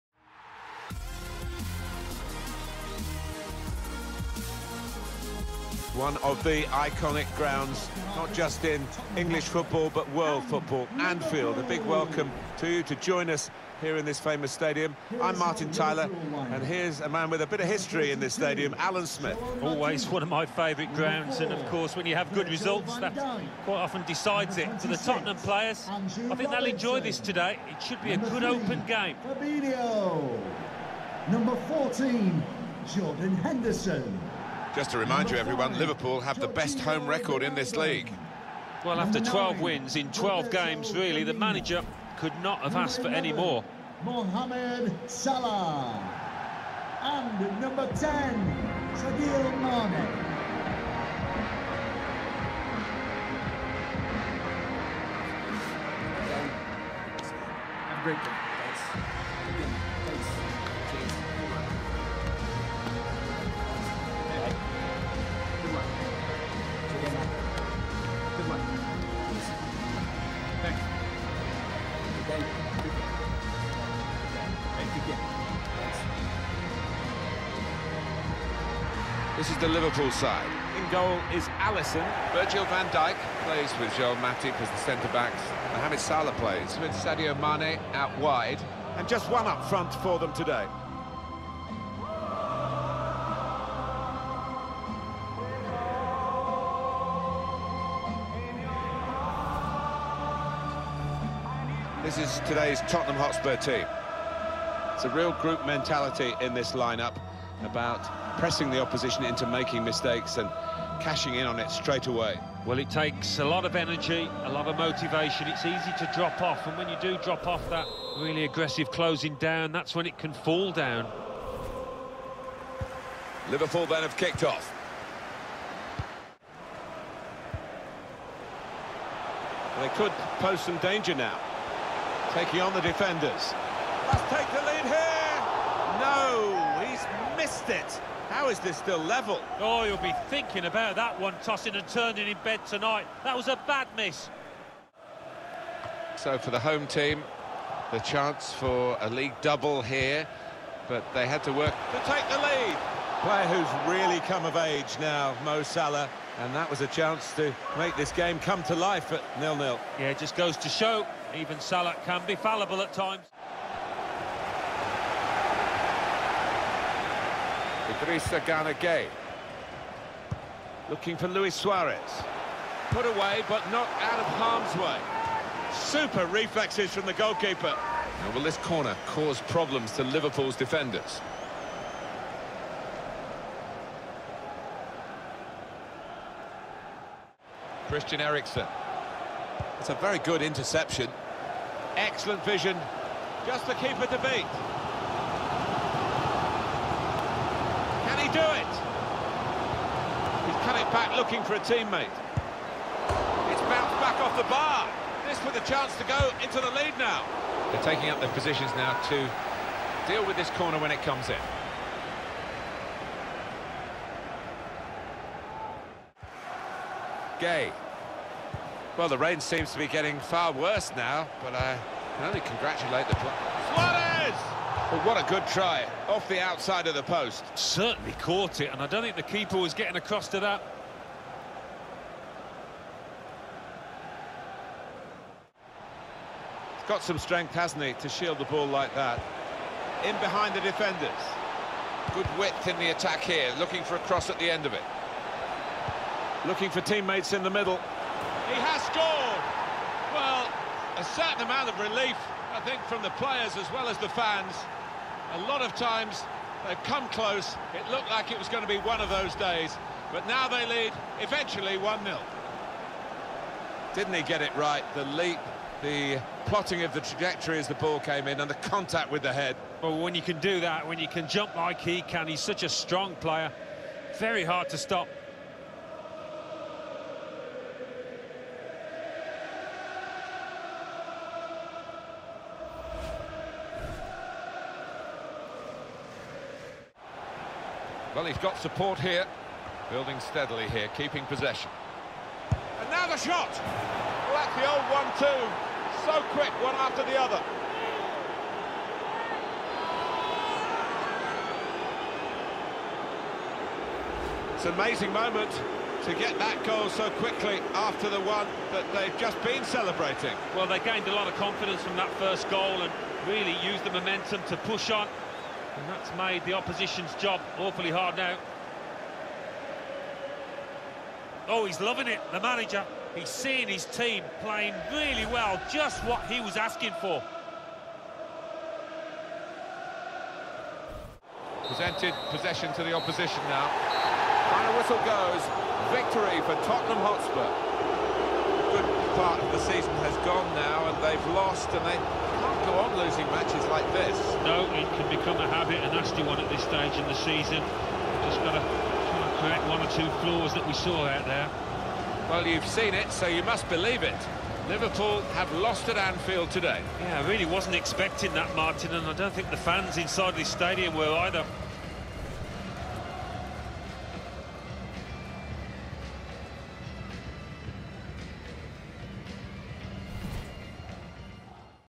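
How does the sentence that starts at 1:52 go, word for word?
Well, it takes a lot of energy, a lot of motivation.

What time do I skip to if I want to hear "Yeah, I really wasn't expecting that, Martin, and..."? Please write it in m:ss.
5:57.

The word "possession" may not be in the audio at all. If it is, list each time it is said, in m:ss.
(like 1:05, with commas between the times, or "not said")
4:51, 5:32.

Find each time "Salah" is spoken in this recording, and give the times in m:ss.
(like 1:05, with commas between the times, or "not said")
0:45, 1:25, 2:35, 2:41.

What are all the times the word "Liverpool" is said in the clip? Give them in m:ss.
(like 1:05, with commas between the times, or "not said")
0:35, 1:19, 2:03, 3:00, 5:54.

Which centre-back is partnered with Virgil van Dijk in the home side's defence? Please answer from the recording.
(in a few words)
Joel Matip.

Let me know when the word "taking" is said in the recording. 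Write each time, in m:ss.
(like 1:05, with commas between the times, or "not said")
2:12, 3:27.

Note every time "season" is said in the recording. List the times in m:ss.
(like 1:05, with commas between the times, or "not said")
5:39, 5:47.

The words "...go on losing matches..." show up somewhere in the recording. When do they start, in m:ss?
5:42.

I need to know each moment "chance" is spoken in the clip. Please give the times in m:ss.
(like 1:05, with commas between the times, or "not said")
2:27, 2:36, 3:25.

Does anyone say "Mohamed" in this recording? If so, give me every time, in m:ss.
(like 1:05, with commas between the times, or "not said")
0:44, 1:25.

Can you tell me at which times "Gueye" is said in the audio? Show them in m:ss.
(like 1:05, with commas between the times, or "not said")
2:48, 3:37.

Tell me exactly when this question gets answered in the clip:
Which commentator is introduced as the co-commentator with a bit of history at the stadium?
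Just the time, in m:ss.
0:18.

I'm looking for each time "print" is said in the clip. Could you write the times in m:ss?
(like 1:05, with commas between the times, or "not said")
not said.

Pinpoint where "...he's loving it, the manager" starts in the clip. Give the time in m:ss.
5:21.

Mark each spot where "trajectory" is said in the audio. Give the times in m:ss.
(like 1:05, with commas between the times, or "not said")
4:26.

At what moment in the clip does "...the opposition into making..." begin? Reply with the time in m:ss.
1:48.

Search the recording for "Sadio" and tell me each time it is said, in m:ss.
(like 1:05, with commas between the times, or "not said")
0:48, 1:26.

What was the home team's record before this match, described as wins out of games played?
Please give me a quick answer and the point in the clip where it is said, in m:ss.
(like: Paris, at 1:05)
12 wins in 12 games, at 0:39.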